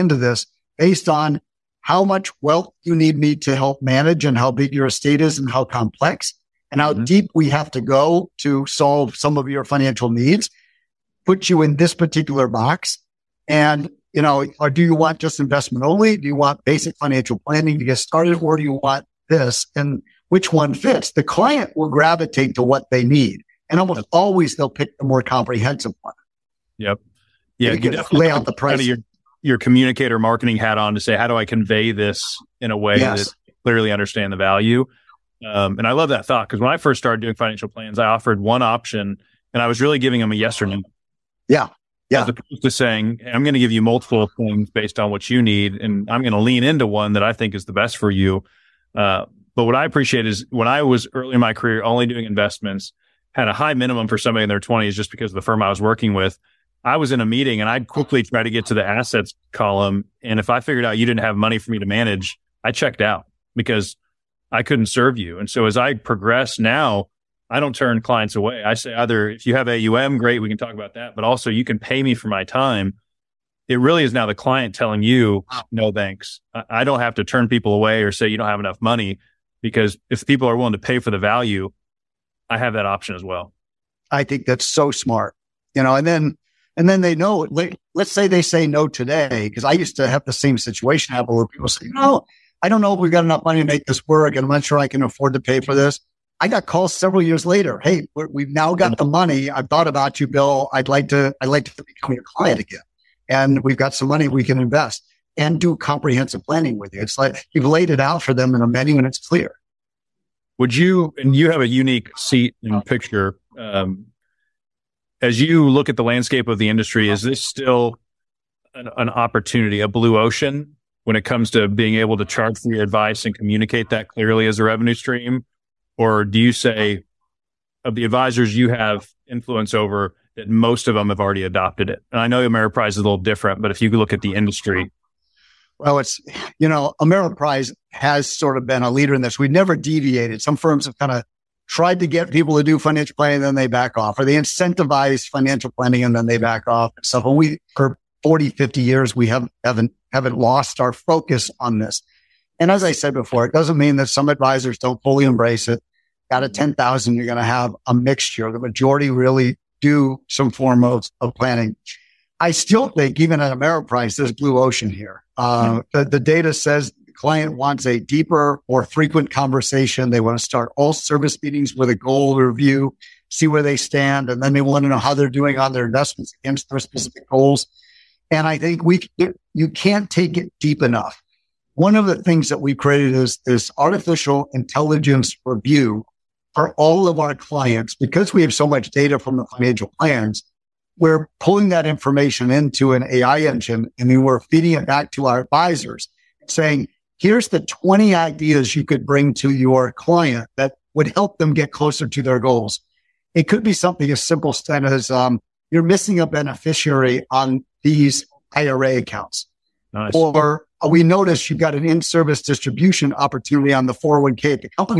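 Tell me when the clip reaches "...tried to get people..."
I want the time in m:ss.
2:21.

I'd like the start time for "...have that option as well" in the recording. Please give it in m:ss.
1:22.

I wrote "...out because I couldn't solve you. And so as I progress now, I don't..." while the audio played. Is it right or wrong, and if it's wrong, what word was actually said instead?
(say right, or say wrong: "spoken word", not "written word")
wrong: "serve", not "solve".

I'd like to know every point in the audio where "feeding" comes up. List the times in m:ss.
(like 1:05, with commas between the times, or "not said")
3:14.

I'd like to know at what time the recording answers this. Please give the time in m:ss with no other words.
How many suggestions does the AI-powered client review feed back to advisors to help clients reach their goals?
3:17.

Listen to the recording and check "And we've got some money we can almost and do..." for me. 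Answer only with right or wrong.
wrong.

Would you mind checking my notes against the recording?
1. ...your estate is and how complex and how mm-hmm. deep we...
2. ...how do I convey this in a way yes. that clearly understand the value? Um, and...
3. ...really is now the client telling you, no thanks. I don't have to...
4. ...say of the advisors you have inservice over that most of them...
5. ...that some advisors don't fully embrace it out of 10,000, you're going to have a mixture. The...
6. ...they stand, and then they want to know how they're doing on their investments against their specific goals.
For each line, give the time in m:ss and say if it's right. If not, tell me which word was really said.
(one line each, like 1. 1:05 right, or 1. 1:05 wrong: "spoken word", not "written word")
1. 0:04 right
2. 0:31 right
3. 1:13 right
4. 2:06 wrong: "influence", not "inservice"
5. 2:33 right
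6. 2:53 right.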